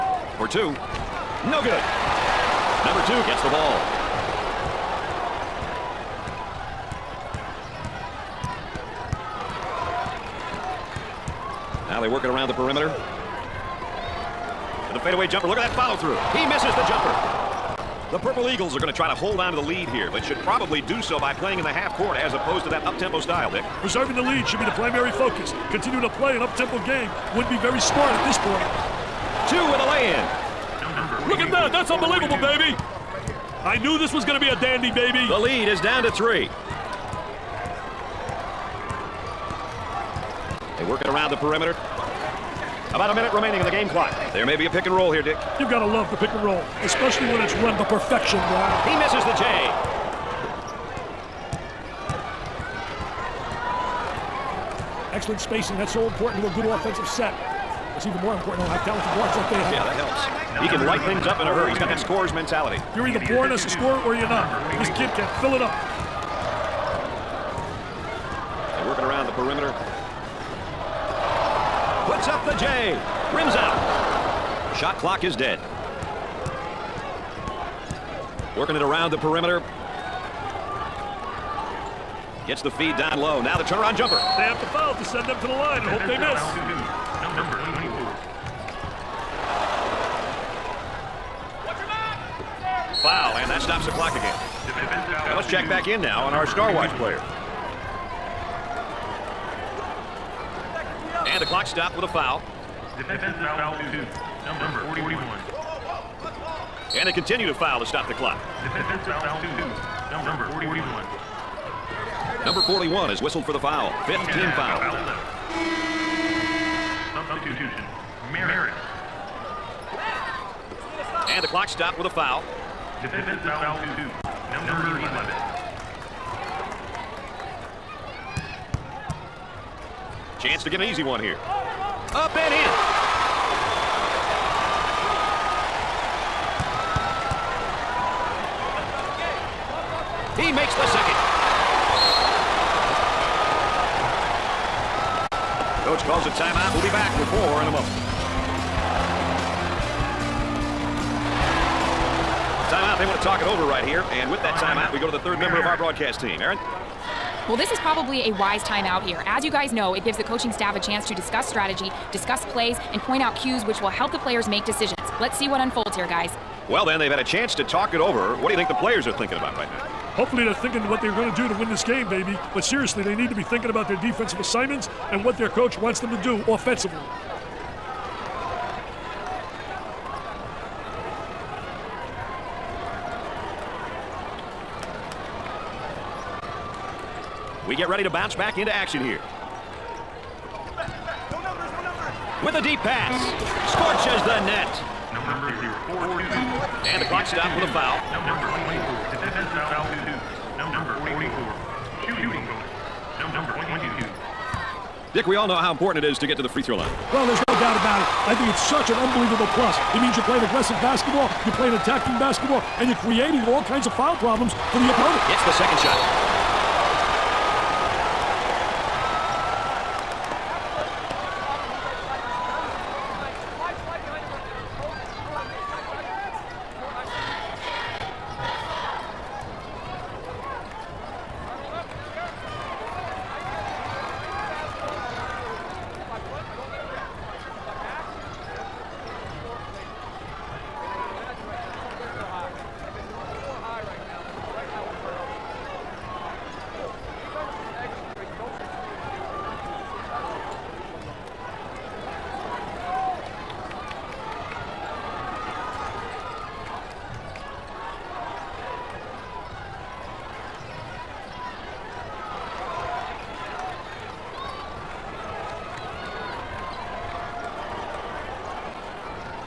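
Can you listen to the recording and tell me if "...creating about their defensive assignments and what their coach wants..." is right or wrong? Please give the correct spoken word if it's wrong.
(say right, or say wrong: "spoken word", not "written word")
wrong: "thinking", not "creating".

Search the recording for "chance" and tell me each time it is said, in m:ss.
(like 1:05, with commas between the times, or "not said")
2:10, 2:40, 2:47.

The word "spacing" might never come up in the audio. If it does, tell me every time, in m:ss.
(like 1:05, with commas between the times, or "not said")
0:55.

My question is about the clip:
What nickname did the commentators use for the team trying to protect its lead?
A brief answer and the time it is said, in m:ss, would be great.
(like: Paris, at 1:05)
Purple Eagles, at 0:18.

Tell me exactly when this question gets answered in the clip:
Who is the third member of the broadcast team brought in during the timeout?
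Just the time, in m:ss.
2:36.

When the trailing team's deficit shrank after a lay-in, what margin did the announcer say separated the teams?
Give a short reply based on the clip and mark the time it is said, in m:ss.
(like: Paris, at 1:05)
3, at 0:35.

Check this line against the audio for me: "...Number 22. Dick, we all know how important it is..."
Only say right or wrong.
right.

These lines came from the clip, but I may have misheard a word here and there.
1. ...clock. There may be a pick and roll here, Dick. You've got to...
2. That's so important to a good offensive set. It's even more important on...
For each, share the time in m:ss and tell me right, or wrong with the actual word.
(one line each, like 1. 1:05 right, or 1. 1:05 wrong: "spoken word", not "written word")
1. 0:43 right
2. 0:55 right.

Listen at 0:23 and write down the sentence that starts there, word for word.
Preserving the lead should be the primary focus.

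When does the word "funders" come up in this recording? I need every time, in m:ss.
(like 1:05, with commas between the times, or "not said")
not said.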